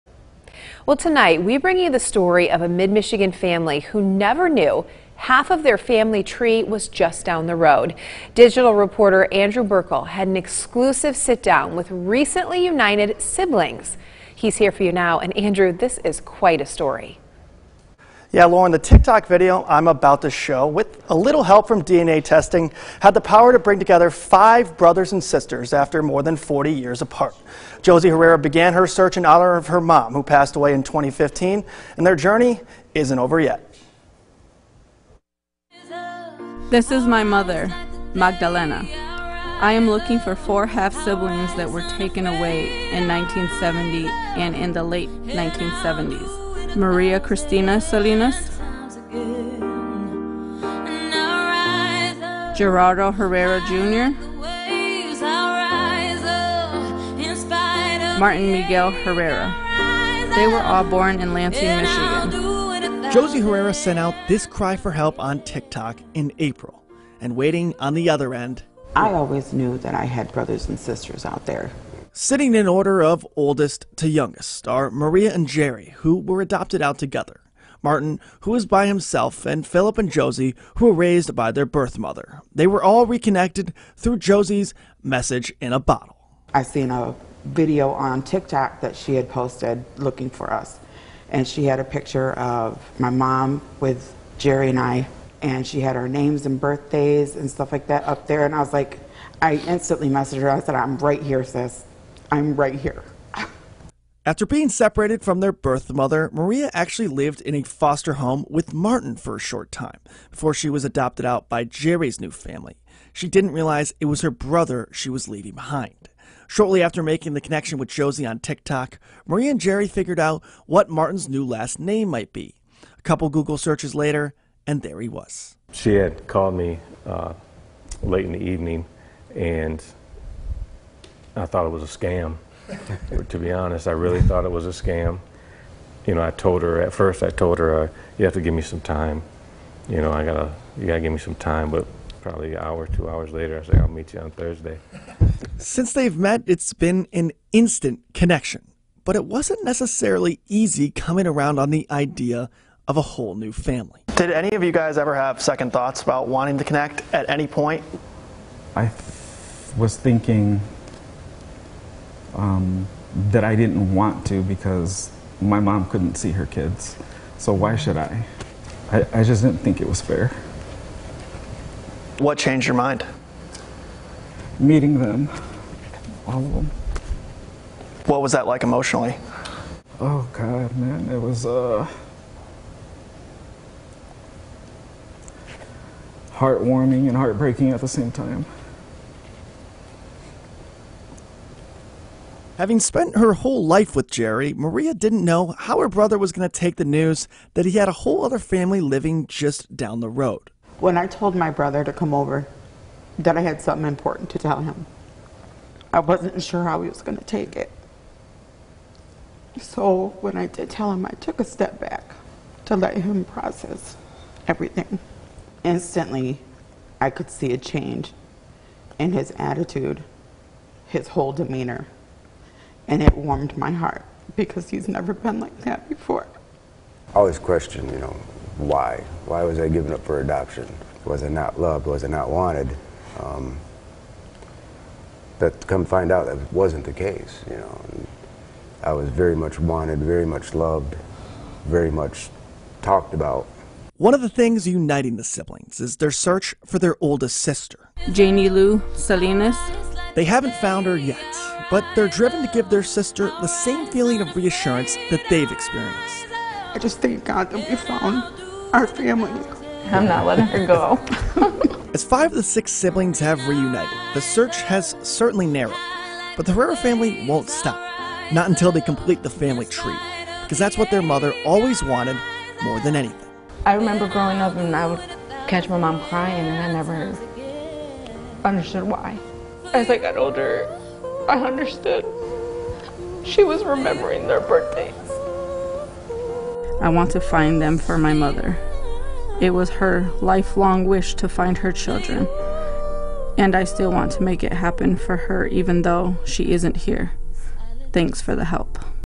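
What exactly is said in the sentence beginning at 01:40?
I said, I'm right here, sis.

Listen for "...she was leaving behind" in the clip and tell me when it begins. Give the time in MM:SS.
01:54.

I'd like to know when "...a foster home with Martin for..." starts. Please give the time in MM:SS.
01:47.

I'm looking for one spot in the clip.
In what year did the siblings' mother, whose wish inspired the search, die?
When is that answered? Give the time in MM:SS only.
00:30.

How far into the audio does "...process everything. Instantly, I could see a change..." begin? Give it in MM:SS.
03:33.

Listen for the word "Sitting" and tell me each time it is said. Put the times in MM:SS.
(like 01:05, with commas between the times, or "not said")
01:12.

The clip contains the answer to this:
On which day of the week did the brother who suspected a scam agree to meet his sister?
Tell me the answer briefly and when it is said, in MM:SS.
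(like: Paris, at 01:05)
Thursday, at 02:24.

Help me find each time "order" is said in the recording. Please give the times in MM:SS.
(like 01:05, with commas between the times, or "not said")
01:12.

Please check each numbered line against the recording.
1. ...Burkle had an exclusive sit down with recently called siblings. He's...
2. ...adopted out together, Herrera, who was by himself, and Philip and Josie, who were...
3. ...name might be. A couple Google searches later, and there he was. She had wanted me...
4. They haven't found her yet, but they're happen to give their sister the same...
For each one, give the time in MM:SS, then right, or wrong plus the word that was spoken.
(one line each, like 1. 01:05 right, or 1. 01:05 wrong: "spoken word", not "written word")
1. 00:09 wrong: "united", not "called"
2. 01:16 wrong: "Martin", not "Herrera"
3. 02:01 wrong: "called", not "wanted"
4. 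04:10 wrong: "driven", not "happen".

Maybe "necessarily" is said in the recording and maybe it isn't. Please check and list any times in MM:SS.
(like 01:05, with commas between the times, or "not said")
02:29.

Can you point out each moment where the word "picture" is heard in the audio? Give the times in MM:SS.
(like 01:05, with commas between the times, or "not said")
01:31.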